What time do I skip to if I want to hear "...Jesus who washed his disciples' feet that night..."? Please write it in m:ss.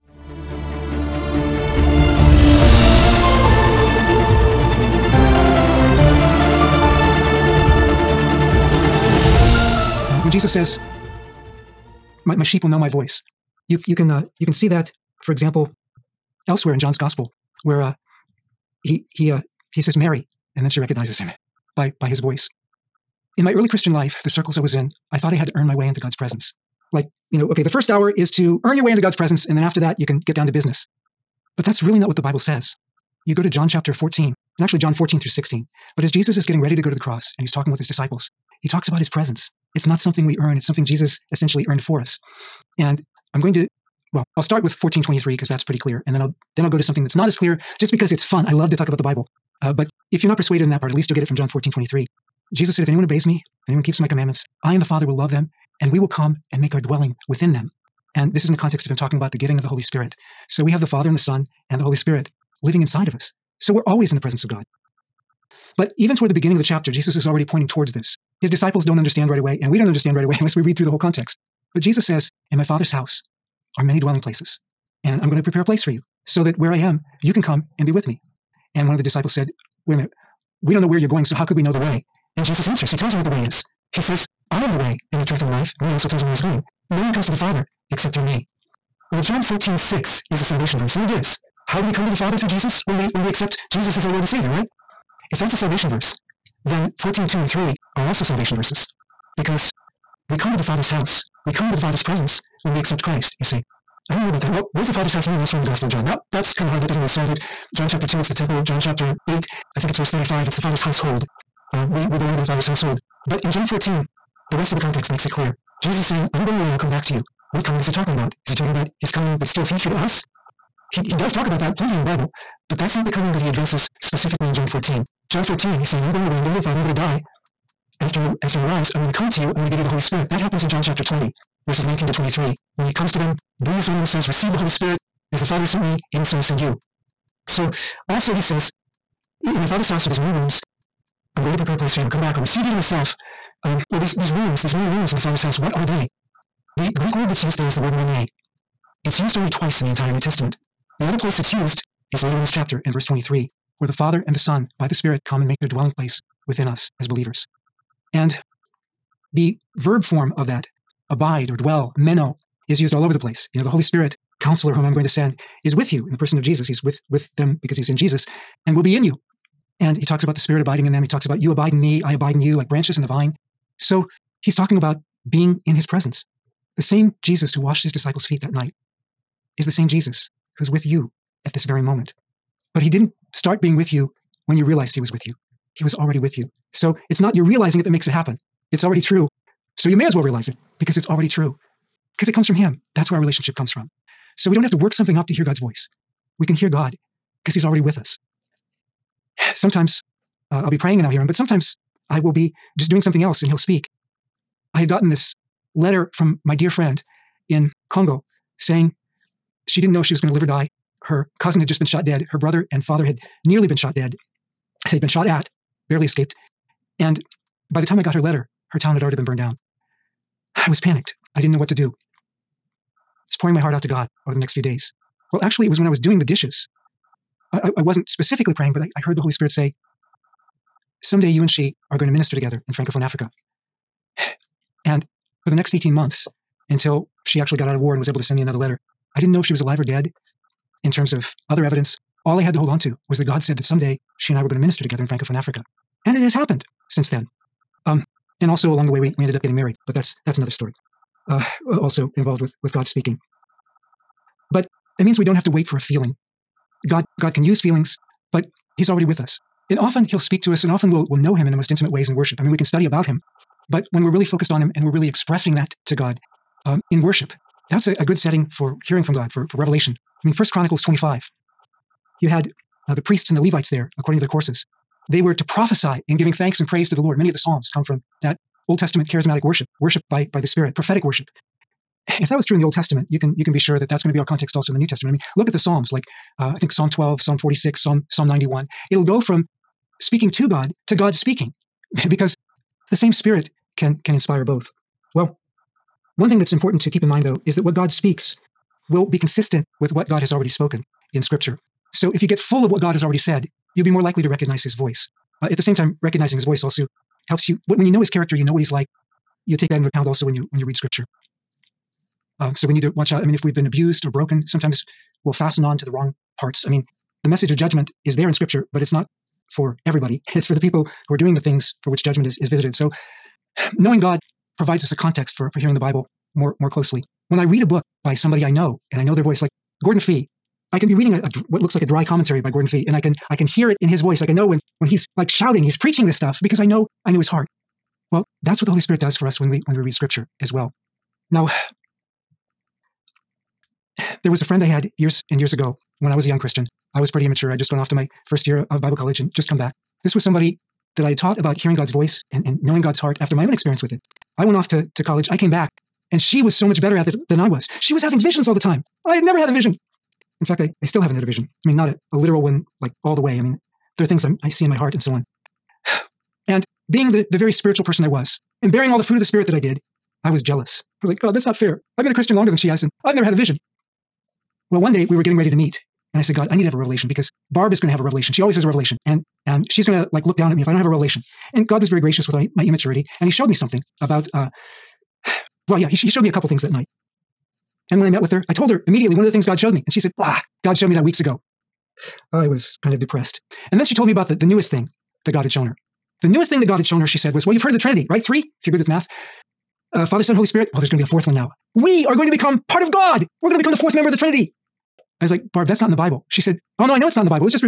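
2:57.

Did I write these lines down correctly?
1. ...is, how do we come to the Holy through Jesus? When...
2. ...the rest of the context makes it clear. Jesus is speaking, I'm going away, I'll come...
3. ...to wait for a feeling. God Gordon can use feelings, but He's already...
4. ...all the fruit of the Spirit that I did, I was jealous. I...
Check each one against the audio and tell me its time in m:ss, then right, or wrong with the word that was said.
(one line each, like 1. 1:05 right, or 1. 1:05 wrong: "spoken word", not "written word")
1. 1:31 wrong: "Father", not "Holy"
2. 1:54 wrong: "saying", not "speaking"
3. 4:15 wrong: "God", not "Gordon"
4. 6:08 right.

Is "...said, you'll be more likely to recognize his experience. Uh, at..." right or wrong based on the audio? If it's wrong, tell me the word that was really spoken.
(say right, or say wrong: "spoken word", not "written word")
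wrong: "voice", not "experience".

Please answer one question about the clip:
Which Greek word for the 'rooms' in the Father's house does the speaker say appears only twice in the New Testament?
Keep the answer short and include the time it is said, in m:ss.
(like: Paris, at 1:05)
mone, at 2:27.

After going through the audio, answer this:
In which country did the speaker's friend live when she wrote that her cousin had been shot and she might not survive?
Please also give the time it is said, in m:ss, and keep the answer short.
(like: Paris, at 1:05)
Congo, at 3:27.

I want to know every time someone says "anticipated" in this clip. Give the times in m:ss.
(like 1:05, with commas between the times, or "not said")
not said.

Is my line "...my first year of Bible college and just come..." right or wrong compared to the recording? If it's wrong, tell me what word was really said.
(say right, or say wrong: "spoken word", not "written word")
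right.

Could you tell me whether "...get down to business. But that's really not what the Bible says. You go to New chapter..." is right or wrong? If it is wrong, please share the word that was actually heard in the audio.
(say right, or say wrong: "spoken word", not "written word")
wrong: "John", not "New".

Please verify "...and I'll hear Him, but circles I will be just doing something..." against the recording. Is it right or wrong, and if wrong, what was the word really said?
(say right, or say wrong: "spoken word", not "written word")
wrong: "sometimes", not "circles".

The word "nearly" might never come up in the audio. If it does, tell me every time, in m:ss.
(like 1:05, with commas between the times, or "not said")
3:33.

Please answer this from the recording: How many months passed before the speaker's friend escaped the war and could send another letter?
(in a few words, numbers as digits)
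18.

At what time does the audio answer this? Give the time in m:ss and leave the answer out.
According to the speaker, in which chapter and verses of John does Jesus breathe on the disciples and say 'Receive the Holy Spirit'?
2:10.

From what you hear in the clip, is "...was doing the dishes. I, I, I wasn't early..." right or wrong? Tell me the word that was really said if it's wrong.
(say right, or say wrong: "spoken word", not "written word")
wrong: "specifically", not "early".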